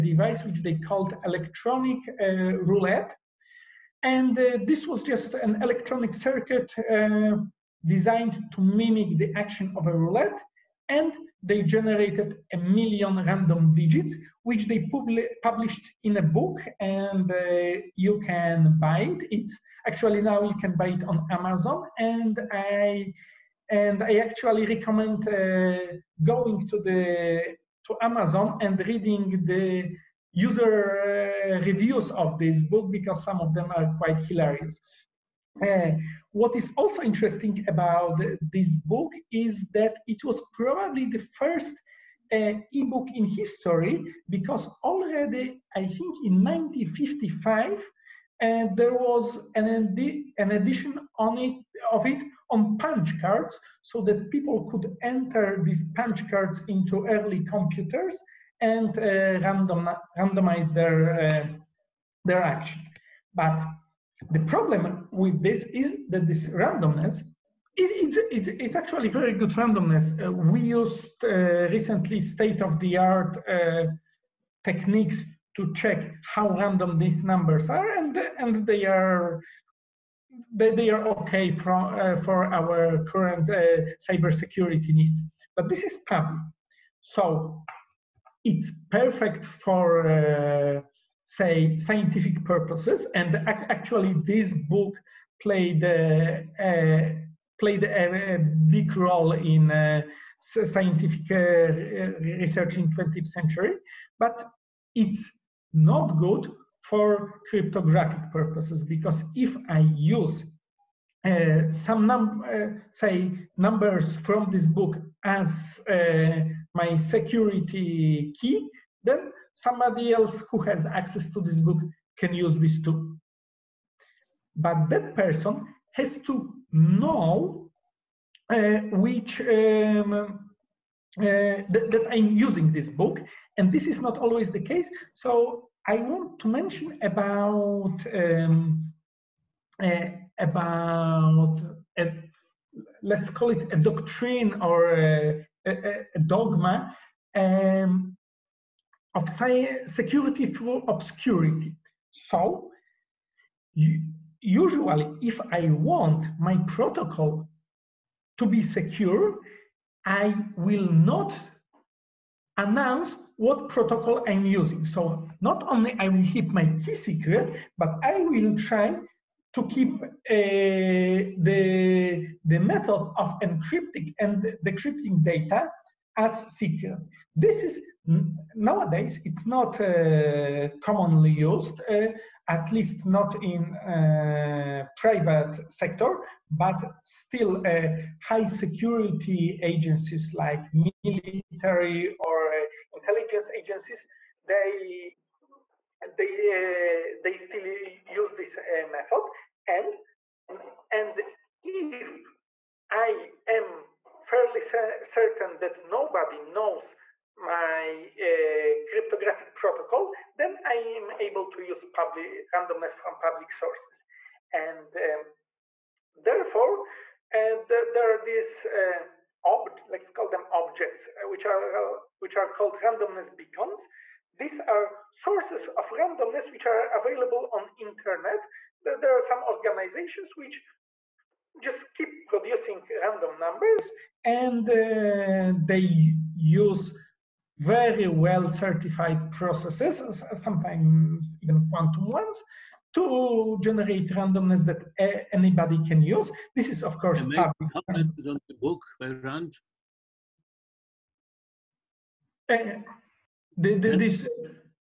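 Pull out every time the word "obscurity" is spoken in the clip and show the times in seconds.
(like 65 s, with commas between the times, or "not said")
150 s.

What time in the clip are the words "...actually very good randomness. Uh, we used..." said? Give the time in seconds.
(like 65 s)
68 s.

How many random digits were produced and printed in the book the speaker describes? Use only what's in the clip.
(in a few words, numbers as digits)
a million.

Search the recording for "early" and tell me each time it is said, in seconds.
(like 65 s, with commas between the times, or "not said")
57 s.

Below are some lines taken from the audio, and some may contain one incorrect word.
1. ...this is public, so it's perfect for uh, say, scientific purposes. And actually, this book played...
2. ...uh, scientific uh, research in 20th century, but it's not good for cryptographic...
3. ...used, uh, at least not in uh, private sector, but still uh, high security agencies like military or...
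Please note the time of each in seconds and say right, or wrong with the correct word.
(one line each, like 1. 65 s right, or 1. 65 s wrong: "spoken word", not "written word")
1. 85 s right
2. 99 s right
3. 181 s right.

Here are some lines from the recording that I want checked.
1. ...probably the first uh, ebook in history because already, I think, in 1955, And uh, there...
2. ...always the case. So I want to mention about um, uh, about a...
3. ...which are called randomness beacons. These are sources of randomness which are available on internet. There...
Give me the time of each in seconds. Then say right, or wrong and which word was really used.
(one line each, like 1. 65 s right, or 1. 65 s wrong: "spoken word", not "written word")
1. 40 s right
2. 134 s right
3. 222 s right.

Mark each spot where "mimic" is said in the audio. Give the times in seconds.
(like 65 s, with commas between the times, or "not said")
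8 s.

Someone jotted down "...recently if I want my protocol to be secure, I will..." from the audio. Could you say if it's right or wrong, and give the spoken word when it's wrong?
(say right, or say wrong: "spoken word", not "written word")
wrong: "usually", not "recently".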